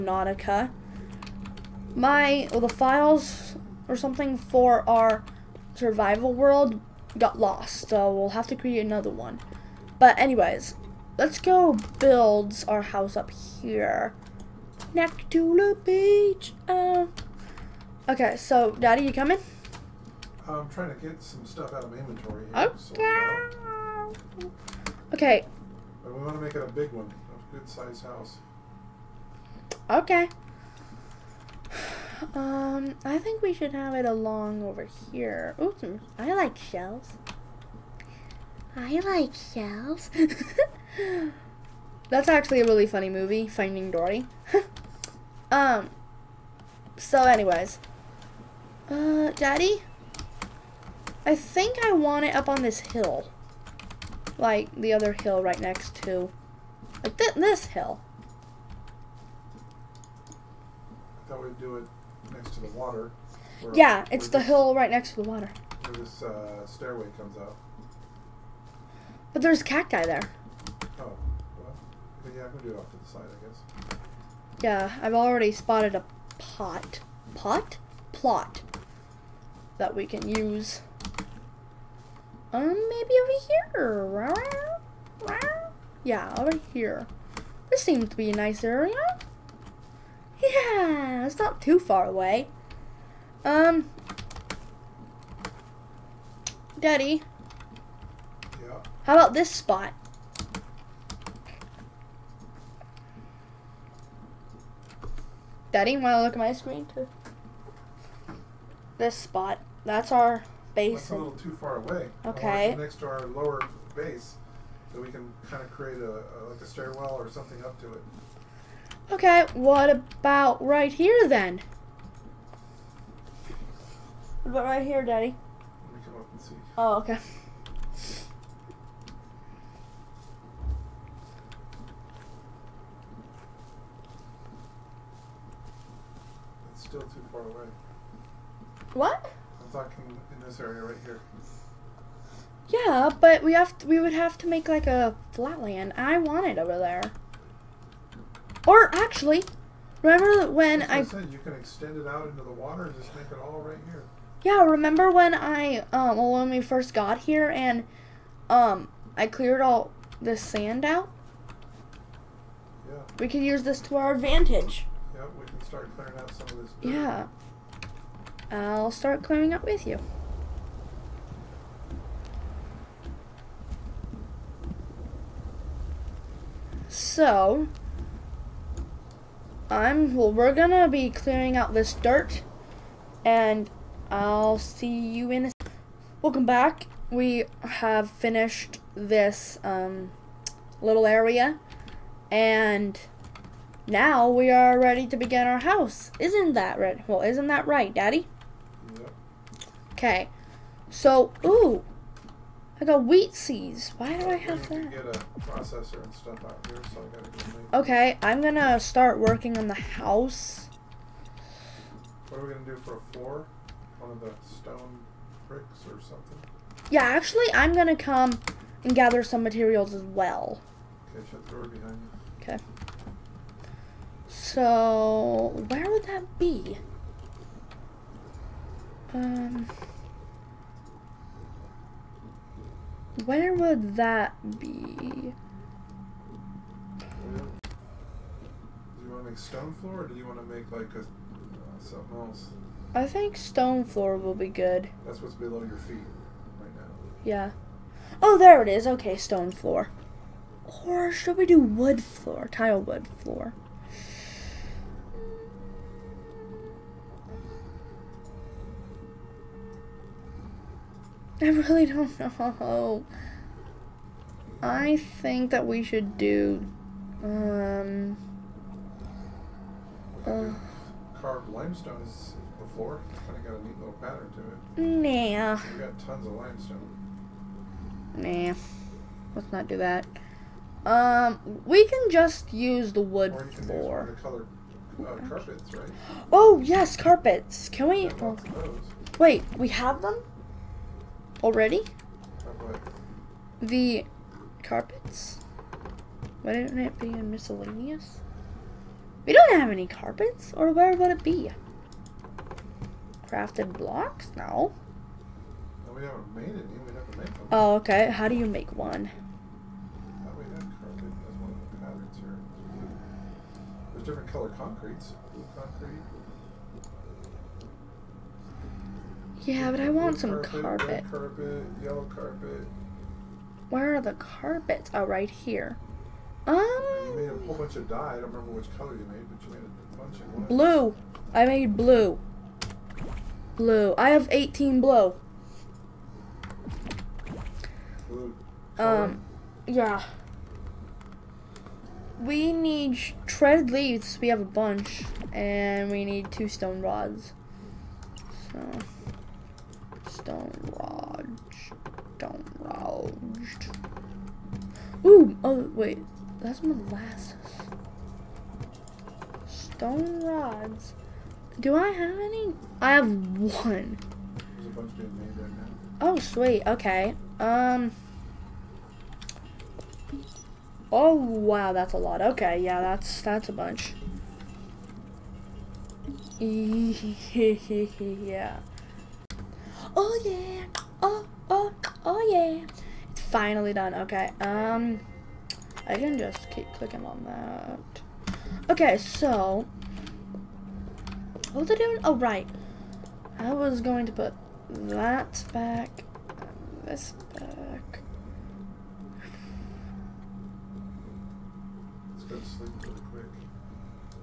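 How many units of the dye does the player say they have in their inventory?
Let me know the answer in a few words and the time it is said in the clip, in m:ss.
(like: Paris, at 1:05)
18, at 5:34.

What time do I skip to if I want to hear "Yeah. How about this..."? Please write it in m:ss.
1:38.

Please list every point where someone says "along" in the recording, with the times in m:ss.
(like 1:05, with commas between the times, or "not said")
0:34.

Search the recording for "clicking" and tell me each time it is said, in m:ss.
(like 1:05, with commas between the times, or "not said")
6:26.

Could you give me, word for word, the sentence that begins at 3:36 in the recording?
Yeah, actually, I'm gonna come and gather some materials as well.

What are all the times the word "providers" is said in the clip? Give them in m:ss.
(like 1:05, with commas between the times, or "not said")
not said.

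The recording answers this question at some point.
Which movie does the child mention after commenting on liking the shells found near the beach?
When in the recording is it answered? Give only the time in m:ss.
0:43.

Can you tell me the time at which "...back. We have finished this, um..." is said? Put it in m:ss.
3:06.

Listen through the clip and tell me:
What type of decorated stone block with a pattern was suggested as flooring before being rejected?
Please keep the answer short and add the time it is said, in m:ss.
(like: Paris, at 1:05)
Carved limestone, at 4:31.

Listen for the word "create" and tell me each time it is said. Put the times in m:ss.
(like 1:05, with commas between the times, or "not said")
0:08, 1:55.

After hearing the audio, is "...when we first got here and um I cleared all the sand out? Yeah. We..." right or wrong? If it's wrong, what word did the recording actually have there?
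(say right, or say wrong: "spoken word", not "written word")
right.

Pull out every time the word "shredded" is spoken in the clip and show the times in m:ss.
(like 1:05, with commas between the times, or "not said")
5:43.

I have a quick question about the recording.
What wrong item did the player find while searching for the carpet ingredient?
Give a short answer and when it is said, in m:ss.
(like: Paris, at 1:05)
molasses, at 5:56.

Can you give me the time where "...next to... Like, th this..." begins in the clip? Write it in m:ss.
0:55.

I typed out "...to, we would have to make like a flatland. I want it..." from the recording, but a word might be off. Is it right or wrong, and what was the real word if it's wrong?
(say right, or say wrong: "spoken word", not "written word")
right.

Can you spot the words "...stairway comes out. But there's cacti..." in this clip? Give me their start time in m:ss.
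1:06.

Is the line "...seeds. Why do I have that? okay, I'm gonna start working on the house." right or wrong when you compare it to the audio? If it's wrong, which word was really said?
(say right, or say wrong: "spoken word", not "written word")
right.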